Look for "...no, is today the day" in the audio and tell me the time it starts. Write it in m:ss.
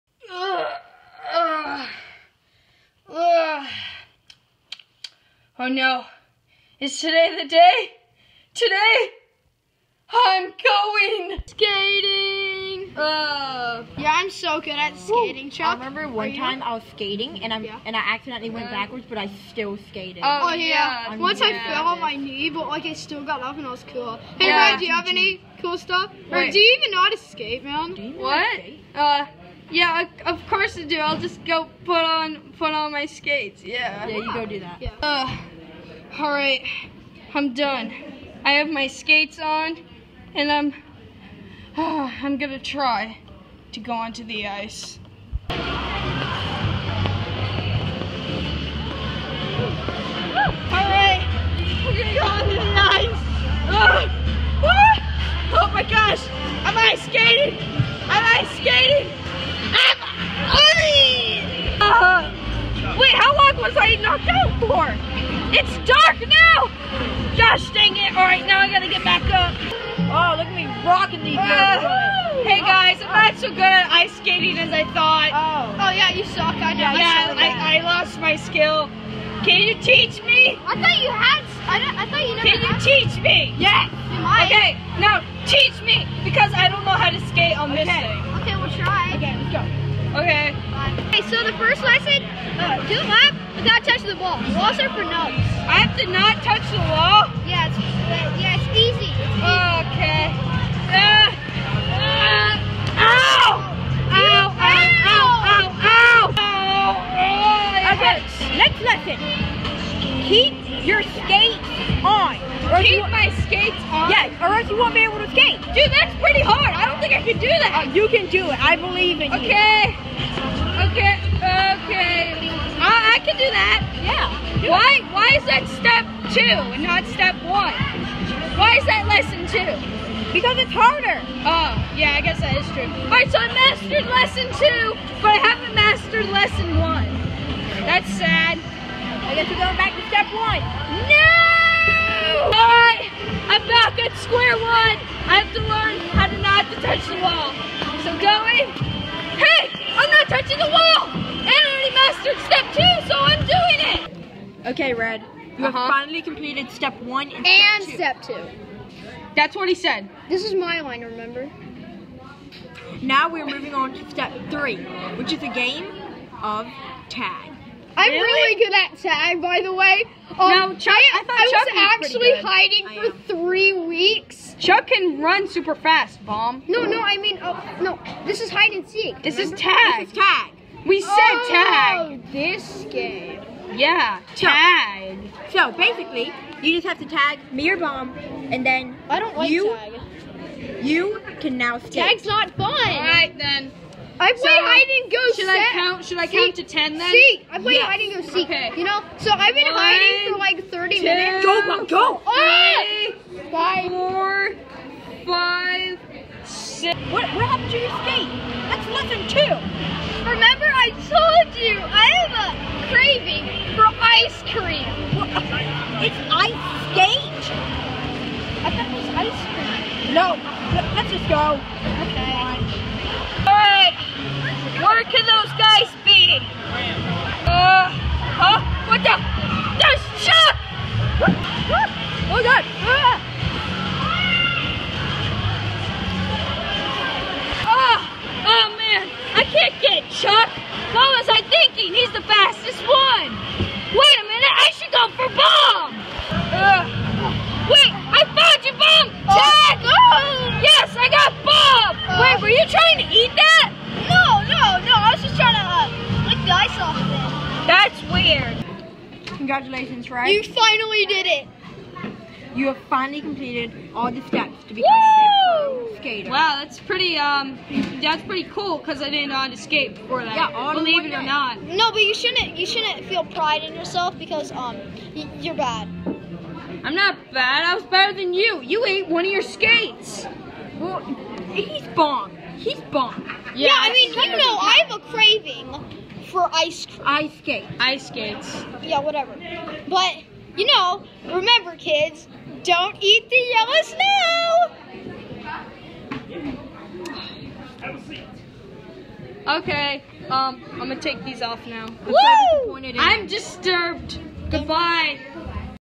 0:05.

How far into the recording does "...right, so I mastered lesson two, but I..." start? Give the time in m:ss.
2:13.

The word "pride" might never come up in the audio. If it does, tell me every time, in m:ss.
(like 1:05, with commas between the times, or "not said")
4:33.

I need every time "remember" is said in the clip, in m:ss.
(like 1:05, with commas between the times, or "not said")
0:15, 2:41, 2:59, 3:30, 4:51.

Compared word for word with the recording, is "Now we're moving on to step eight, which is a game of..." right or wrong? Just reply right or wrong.
wrong.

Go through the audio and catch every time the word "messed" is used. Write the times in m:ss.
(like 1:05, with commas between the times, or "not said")
not said.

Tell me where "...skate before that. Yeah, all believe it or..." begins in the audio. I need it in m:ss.
4:29.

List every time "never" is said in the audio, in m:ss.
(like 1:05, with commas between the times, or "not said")
1:22.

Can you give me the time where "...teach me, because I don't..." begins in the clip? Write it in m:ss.
1:25.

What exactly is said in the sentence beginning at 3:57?
Oh, oh man, I can't get Chuck!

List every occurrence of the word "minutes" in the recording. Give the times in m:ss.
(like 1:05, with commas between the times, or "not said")
3:21, 4:04.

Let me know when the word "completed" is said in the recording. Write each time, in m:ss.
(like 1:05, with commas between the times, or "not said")
2:36, 4:23.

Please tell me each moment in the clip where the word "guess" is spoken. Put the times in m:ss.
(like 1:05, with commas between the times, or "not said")
2:12, 2:19.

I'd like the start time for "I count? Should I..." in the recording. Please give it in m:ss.
3:15.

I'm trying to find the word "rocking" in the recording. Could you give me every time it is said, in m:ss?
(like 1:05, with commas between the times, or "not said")
1:10.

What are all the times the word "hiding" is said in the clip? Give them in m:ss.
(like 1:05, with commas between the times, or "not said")
2:52, 3:19.